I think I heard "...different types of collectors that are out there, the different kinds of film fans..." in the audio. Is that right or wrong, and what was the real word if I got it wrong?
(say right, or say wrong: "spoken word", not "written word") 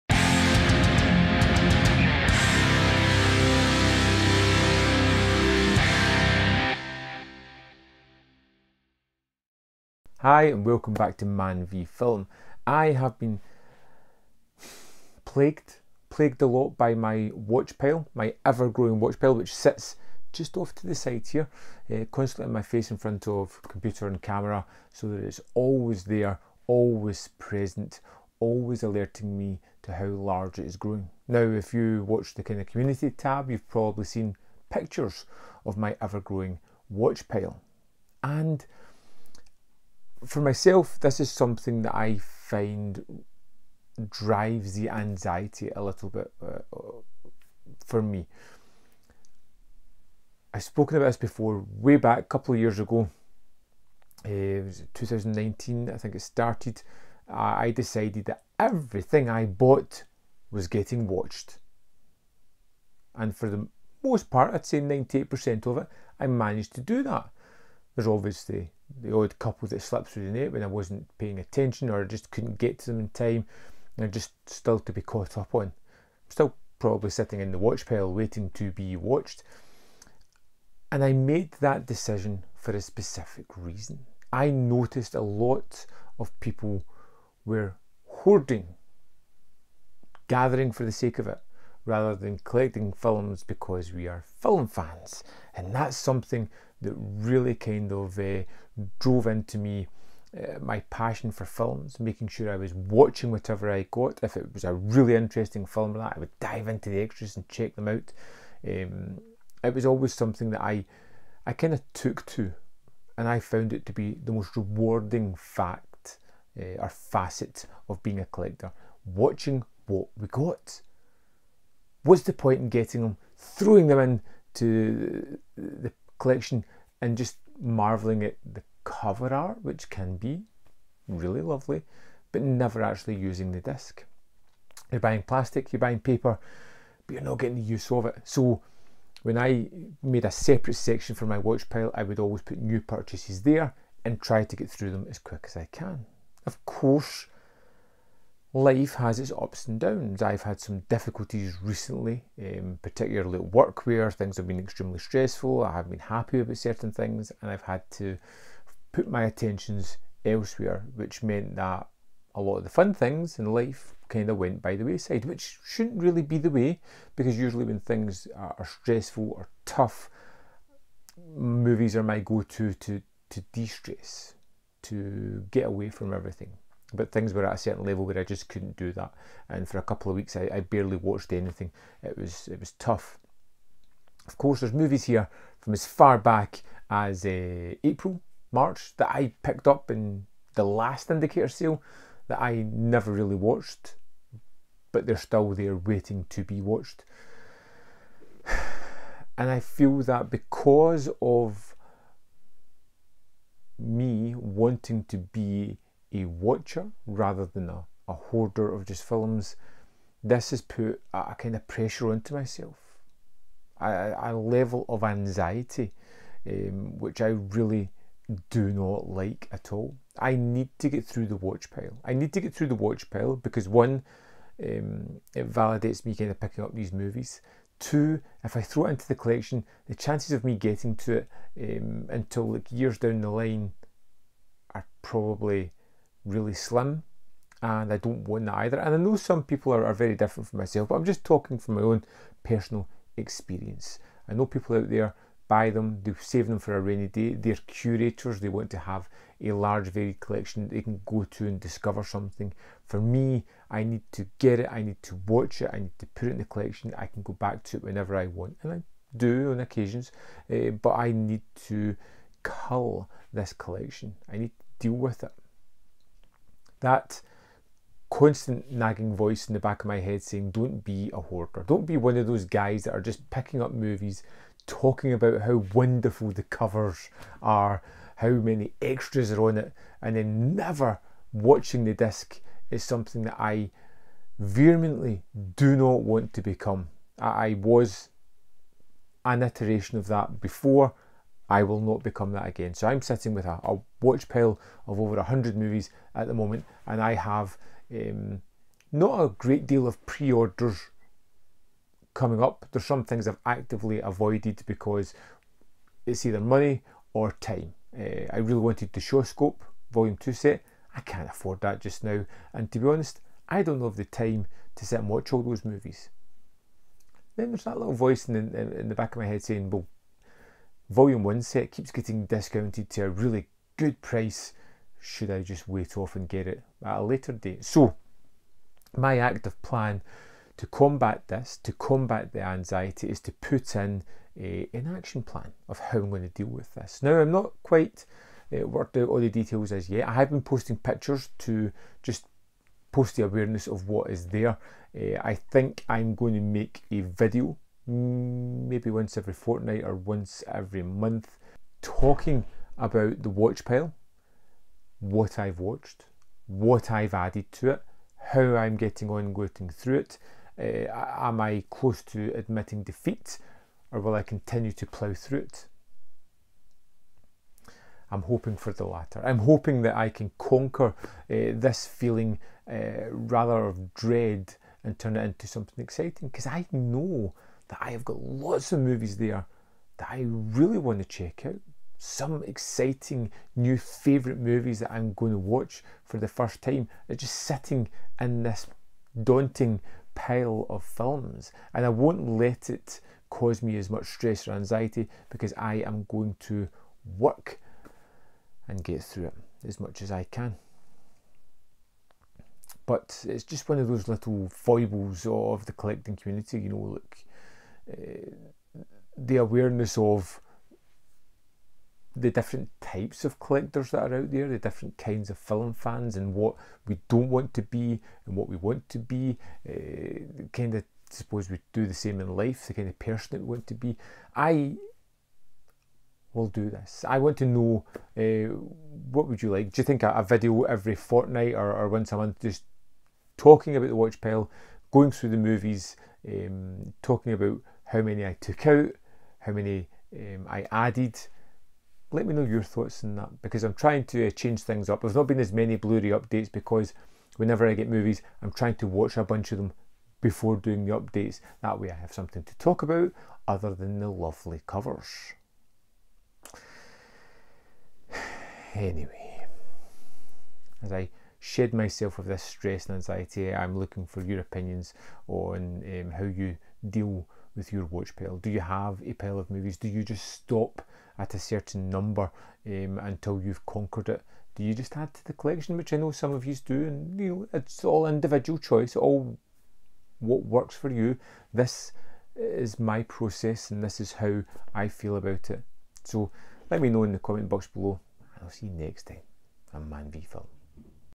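right.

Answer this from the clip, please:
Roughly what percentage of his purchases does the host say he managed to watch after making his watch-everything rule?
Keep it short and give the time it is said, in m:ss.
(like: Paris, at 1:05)
98%, at 1:04.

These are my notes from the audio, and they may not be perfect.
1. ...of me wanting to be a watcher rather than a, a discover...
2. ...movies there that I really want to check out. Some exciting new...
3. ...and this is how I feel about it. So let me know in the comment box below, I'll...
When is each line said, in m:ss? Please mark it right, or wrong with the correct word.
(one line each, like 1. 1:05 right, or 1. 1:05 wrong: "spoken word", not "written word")
1. 3:21 wrong: "hoarder", not "discover"
2. 6:18 right
3. 8:03 right.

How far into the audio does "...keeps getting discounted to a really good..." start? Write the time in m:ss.
5:21.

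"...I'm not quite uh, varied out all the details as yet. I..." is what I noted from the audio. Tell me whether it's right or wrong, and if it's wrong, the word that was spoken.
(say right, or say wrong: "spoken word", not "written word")
wrong: "worked", not "varied".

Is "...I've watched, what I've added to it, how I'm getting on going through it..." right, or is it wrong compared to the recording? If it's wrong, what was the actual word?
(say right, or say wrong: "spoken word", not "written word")
right.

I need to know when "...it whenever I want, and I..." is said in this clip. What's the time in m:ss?
4:17.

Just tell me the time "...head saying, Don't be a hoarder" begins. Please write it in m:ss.
4:29.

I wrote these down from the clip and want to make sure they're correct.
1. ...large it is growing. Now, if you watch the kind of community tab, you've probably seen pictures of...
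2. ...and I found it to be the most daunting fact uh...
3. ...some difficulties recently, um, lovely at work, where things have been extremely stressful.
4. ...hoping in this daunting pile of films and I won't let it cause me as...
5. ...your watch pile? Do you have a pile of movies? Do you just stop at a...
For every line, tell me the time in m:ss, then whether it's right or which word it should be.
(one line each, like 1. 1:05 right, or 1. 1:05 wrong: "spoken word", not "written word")
1. 0:30 right
2. 1:53 wrong: "rewarding", not "daunting"
3. 2:30 wrong: "particularly", not "lovely"
4. 6:27 wrong: "sitting", not "hoping"
5. 7:47 right.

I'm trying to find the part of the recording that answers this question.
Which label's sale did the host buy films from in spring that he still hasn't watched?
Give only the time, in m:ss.
3:11.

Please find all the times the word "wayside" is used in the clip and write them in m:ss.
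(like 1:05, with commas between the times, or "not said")
2:44.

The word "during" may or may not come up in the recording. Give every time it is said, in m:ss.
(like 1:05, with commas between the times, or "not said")
not said.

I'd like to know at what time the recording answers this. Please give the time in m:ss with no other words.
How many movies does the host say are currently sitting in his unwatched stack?
4:55.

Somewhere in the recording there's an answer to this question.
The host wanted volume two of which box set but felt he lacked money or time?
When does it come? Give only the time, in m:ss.
5:08.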